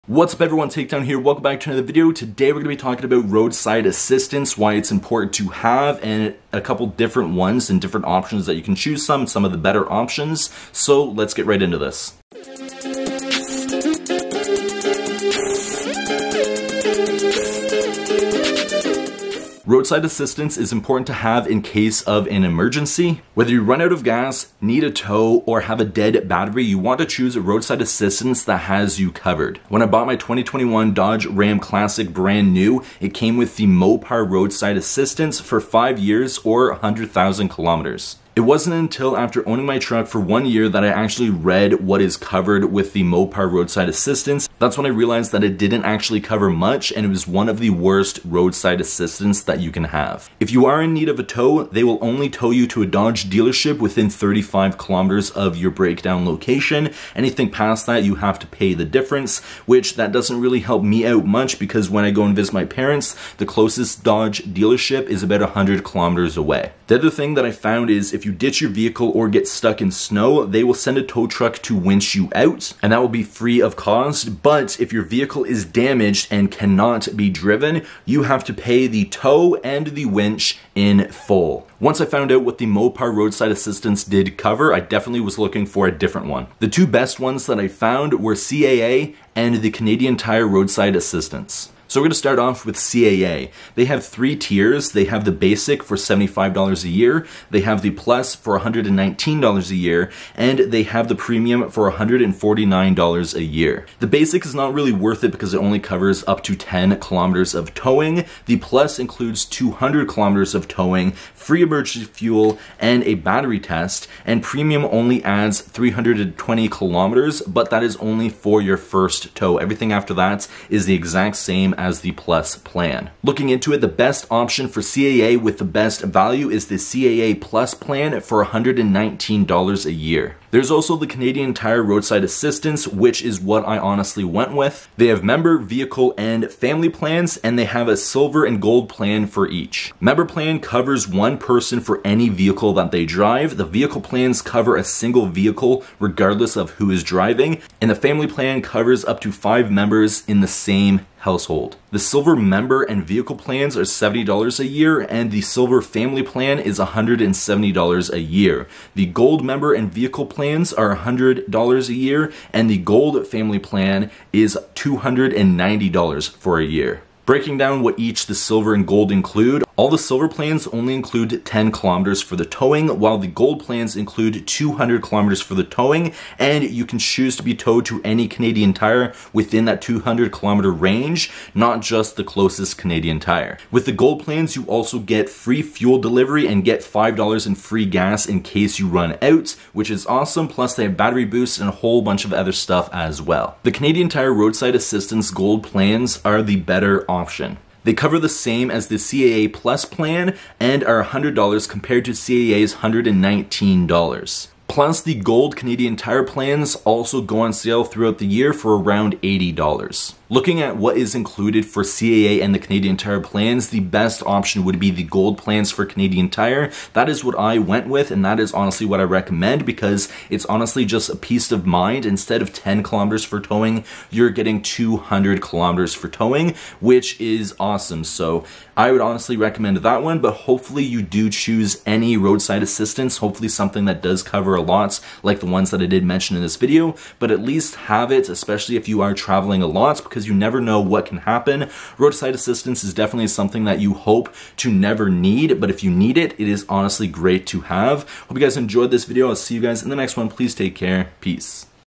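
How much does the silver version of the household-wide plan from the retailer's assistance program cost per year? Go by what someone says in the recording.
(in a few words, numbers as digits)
$170.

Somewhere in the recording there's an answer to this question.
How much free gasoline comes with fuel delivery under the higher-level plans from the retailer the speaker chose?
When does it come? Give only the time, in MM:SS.
03:06.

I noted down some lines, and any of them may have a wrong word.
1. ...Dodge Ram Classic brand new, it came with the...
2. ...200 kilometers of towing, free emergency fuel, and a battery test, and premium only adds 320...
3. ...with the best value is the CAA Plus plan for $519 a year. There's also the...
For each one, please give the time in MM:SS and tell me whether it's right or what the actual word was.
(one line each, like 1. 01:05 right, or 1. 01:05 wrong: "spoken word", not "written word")
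1. 00:30 right
2. 01:49 right
3. 02:05 wrong: "119", not "519".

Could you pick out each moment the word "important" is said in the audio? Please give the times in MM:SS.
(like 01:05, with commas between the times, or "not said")
00:04, 00:20.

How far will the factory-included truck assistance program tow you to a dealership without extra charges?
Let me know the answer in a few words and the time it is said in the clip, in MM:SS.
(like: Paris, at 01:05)
35 kilometers, at 00:54.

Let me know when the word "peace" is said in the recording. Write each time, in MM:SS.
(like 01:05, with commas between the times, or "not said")
03:41, 04:11.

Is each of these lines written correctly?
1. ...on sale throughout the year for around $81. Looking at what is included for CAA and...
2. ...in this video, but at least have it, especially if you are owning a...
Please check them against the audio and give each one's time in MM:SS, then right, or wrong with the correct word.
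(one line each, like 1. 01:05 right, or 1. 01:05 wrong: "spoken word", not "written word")
1. 03:27 wrong: "80", not "81"
2. 03:56 wrong: "traveling", not "owning".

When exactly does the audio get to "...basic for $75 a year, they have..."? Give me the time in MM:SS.
01:35.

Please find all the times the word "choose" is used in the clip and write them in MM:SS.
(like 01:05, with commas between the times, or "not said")
00:08, 00:27, 02:56, 03:51.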